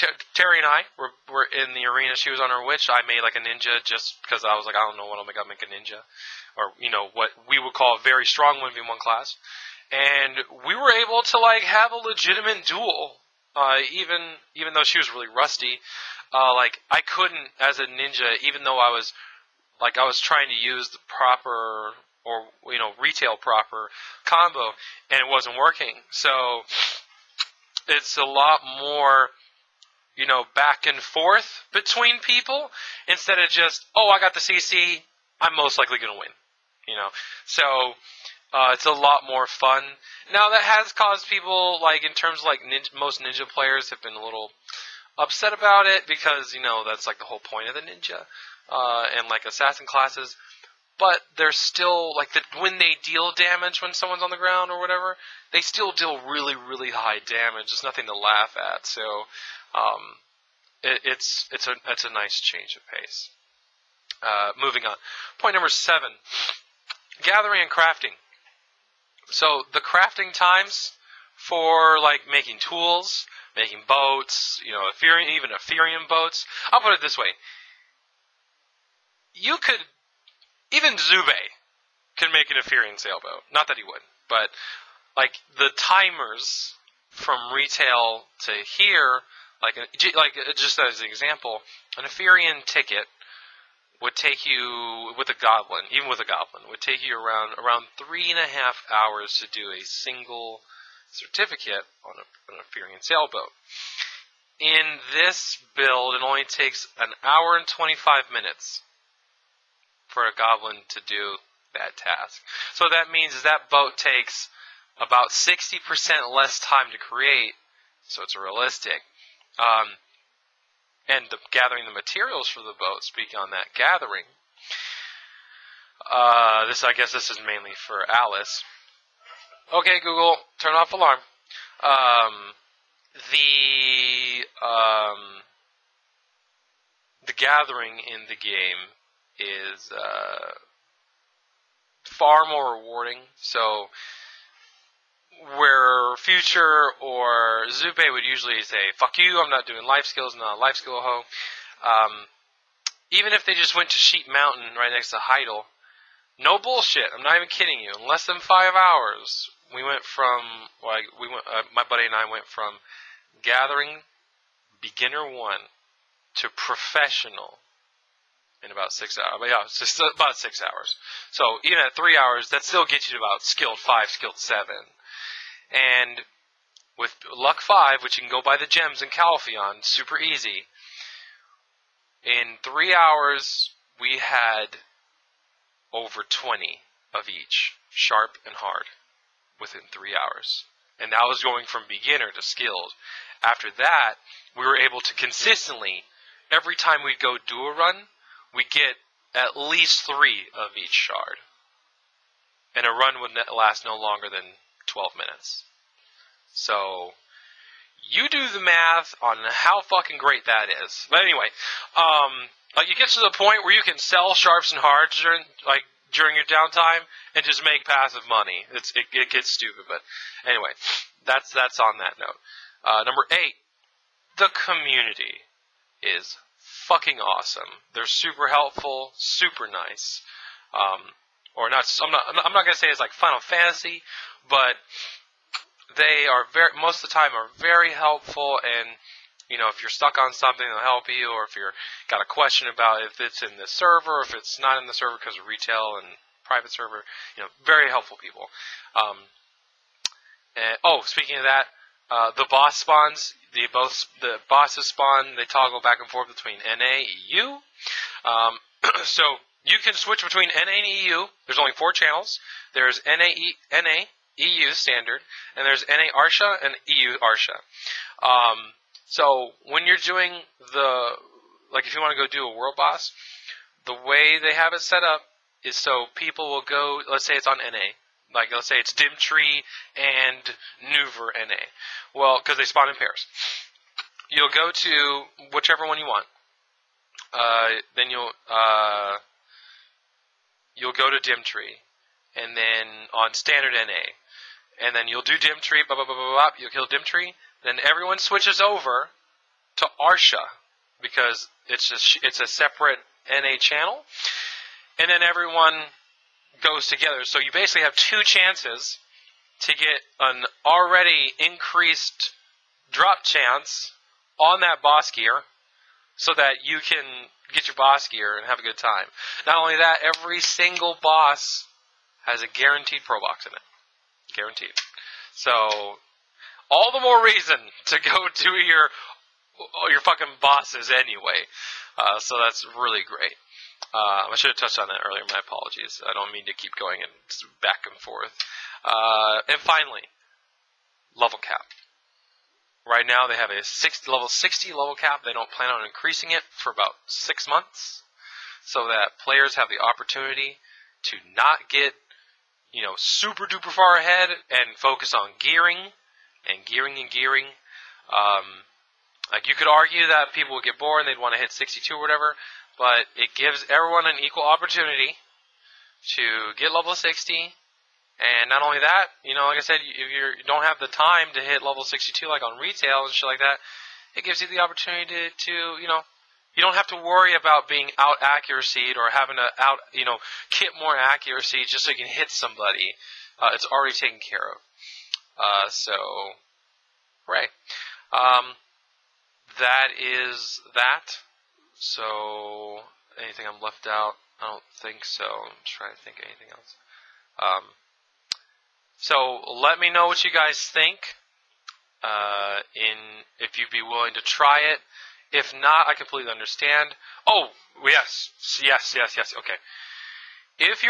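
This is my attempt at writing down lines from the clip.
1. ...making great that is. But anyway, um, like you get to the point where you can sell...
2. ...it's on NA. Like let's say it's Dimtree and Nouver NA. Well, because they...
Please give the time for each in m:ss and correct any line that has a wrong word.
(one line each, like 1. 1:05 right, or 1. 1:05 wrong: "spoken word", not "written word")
1. 3:29 wrong: "fucking", not "making"
2. 4:37 right.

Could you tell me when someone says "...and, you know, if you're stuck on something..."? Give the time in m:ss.
3:58.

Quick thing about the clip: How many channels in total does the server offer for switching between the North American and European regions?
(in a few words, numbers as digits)
4.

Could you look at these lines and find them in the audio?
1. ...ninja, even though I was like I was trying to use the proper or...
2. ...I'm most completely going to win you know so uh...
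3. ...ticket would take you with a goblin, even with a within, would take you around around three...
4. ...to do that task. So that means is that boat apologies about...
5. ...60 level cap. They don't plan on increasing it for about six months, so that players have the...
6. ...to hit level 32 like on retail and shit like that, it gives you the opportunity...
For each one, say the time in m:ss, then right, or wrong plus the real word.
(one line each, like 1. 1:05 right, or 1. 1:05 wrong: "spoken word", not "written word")
1. 0:17 right
2. 0:35 wrong: "likely", not "completely"
3. 1:32 wrong: "goblin", not "within"
4. 1:50 wrong: "takes", not "apologies"
5. 5:44 right
6. 6:11 wrong: "62", not "32".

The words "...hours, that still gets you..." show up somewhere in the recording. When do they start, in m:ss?
2:52.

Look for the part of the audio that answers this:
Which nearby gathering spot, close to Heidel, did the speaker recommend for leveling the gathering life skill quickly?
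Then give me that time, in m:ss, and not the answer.
2:33.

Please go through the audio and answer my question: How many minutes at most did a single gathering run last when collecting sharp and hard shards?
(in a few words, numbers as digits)
12.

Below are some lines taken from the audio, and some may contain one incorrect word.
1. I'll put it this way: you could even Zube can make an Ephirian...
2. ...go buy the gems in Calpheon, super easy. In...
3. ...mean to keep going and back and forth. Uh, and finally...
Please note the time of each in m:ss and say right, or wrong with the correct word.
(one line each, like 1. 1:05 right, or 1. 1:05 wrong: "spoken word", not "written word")
1. 1:16 right
2. 2:58 right
3. 5:36 right.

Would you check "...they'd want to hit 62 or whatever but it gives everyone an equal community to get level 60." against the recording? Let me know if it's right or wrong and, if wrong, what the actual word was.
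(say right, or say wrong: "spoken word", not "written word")
wrong: "opportunity", not "community".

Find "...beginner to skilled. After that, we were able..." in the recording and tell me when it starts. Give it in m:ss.
3:11.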